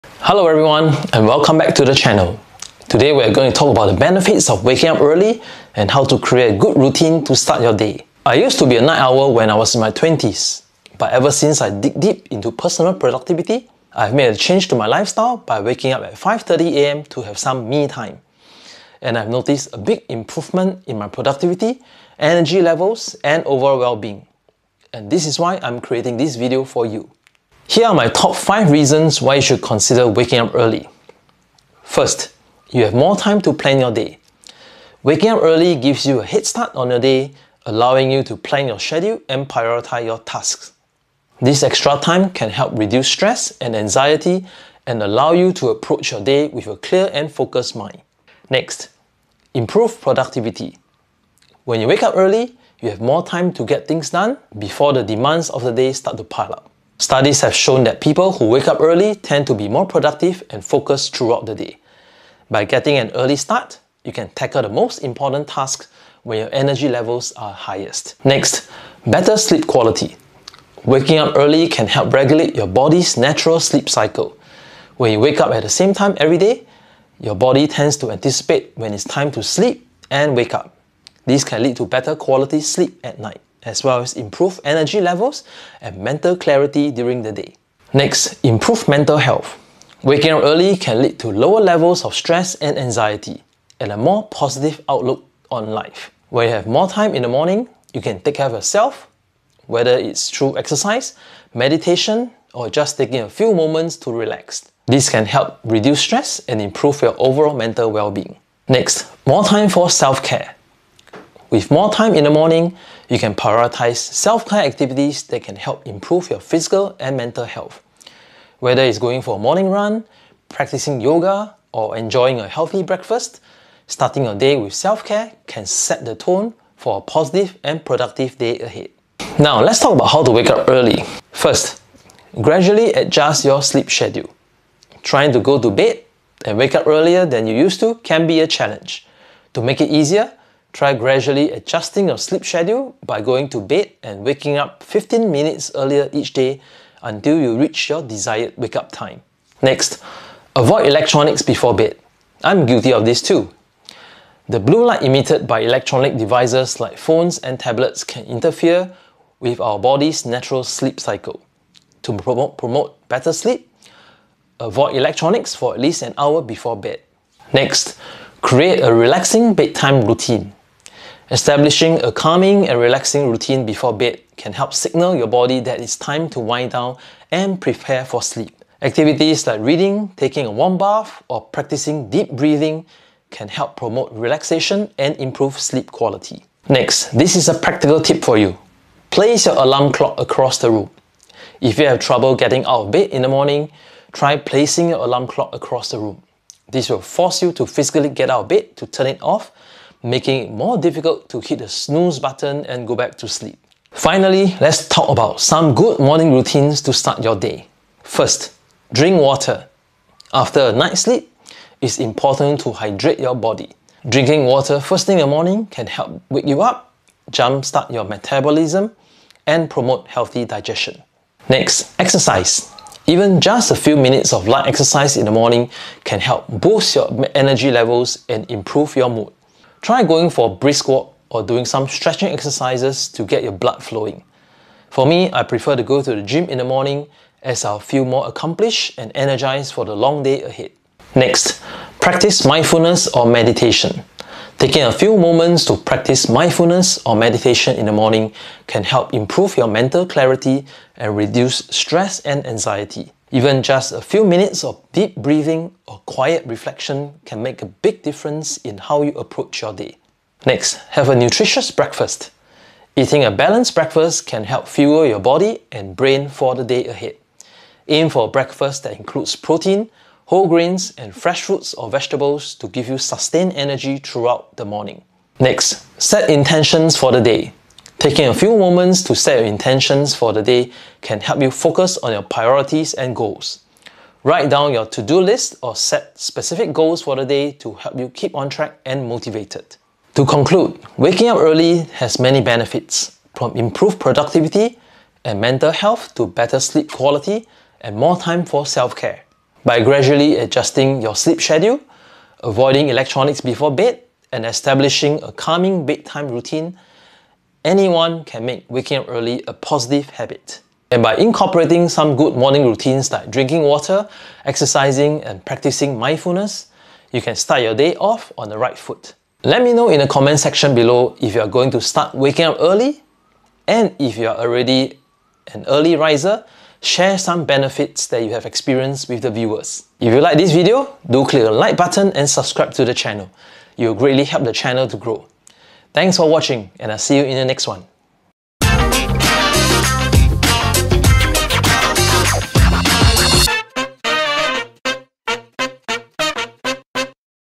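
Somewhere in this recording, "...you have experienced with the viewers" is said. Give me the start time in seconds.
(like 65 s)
328 s.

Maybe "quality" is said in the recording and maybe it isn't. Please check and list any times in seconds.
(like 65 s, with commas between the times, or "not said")
69 s, 82 s, 185 s, 296 s.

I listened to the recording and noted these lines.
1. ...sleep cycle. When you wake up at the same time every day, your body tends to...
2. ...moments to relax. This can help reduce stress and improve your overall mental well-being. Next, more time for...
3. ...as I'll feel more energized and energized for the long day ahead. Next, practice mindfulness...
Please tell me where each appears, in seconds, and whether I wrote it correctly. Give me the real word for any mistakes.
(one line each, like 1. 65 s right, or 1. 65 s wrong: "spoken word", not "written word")
1. 73 s right
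2. 103 s right
3. 237 s wrong: "accomplished", not "energized".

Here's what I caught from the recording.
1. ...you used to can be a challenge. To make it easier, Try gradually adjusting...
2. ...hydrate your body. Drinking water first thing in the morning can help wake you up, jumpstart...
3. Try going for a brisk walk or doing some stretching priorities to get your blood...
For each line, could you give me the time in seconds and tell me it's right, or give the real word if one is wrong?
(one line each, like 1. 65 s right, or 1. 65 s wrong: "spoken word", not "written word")
1. 137 s right
2. 212 s right
3. 229 s wrong: "exercises", not "priorities".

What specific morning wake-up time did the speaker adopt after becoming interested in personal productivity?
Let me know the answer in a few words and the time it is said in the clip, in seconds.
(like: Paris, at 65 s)
5:30am, at 16 s.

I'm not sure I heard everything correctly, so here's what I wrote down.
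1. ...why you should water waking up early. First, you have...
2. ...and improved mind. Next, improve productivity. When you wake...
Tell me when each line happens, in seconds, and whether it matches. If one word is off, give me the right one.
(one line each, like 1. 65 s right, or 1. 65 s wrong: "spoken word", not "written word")
1. 29 s wrong: "consider", not "water"
2. 47 s wrong: "focused", not "improved".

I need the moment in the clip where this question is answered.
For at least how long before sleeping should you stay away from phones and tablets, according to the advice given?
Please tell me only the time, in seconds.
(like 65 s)
166 s.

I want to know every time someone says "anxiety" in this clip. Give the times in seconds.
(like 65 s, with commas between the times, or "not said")
43 s, 92 s, 252 s.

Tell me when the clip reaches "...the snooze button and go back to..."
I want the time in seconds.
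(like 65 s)
201 s.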